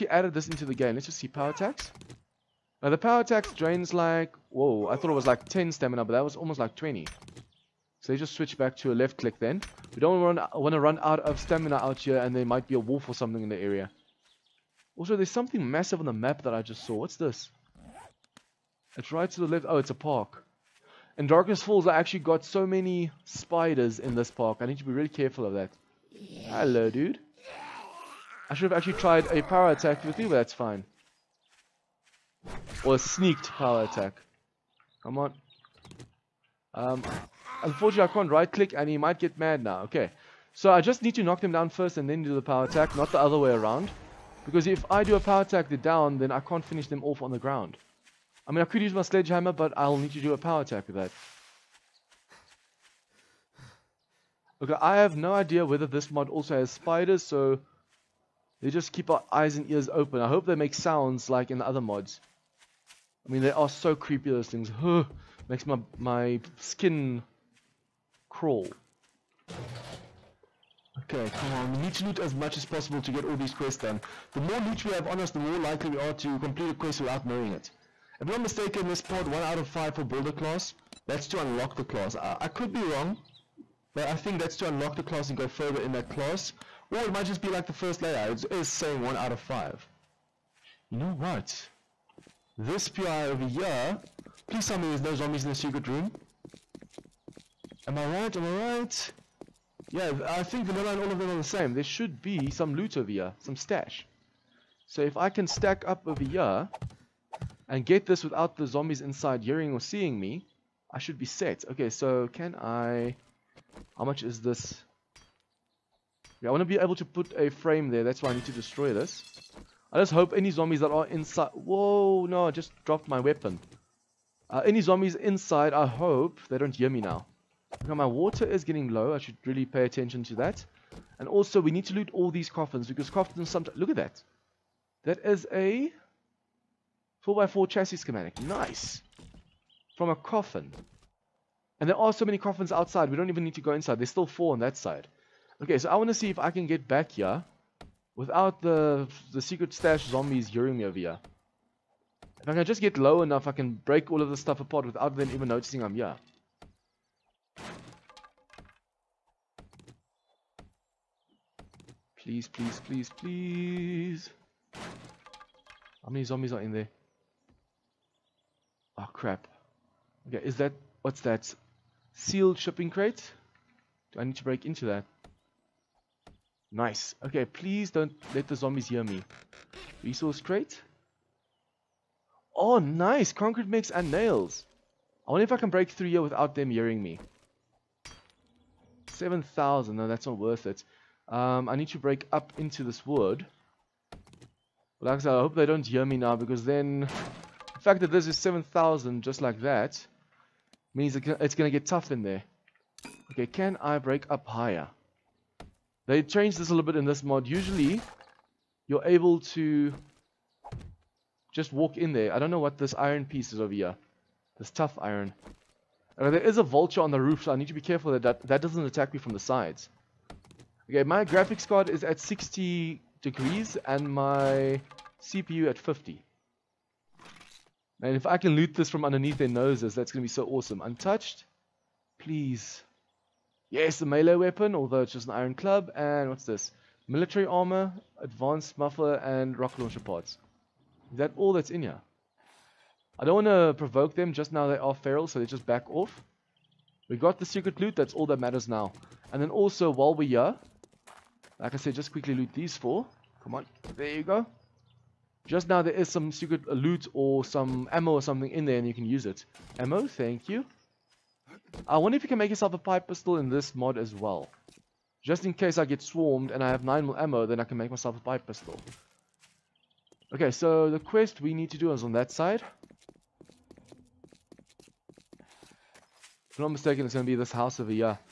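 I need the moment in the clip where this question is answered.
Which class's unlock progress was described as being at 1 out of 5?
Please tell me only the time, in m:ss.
1:20.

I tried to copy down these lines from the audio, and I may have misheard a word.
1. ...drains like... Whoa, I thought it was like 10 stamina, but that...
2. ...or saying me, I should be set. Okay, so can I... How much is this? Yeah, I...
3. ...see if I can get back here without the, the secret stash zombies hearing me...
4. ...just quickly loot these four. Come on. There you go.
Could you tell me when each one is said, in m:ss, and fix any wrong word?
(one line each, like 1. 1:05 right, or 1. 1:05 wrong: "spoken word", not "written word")
1. 0:03 right
2. 1:49 wrong: "seeing", not "saying"
3. 2:26 right
4. 4:11 right.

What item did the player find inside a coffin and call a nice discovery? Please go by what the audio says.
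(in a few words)
4x4 chassis schematic.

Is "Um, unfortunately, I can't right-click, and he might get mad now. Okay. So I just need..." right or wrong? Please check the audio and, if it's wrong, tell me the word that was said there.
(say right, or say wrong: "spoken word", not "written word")
right.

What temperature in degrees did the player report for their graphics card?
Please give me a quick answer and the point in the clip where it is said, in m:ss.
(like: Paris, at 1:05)
60, at 3:42.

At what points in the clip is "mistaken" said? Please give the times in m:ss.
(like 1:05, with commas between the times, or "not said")
1:18, 4:36.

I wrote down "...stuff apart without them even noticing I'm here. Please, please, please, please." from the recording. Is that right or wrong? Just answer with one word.
right.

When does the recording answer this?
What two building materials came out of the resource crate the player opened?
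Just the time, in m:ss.
3:03.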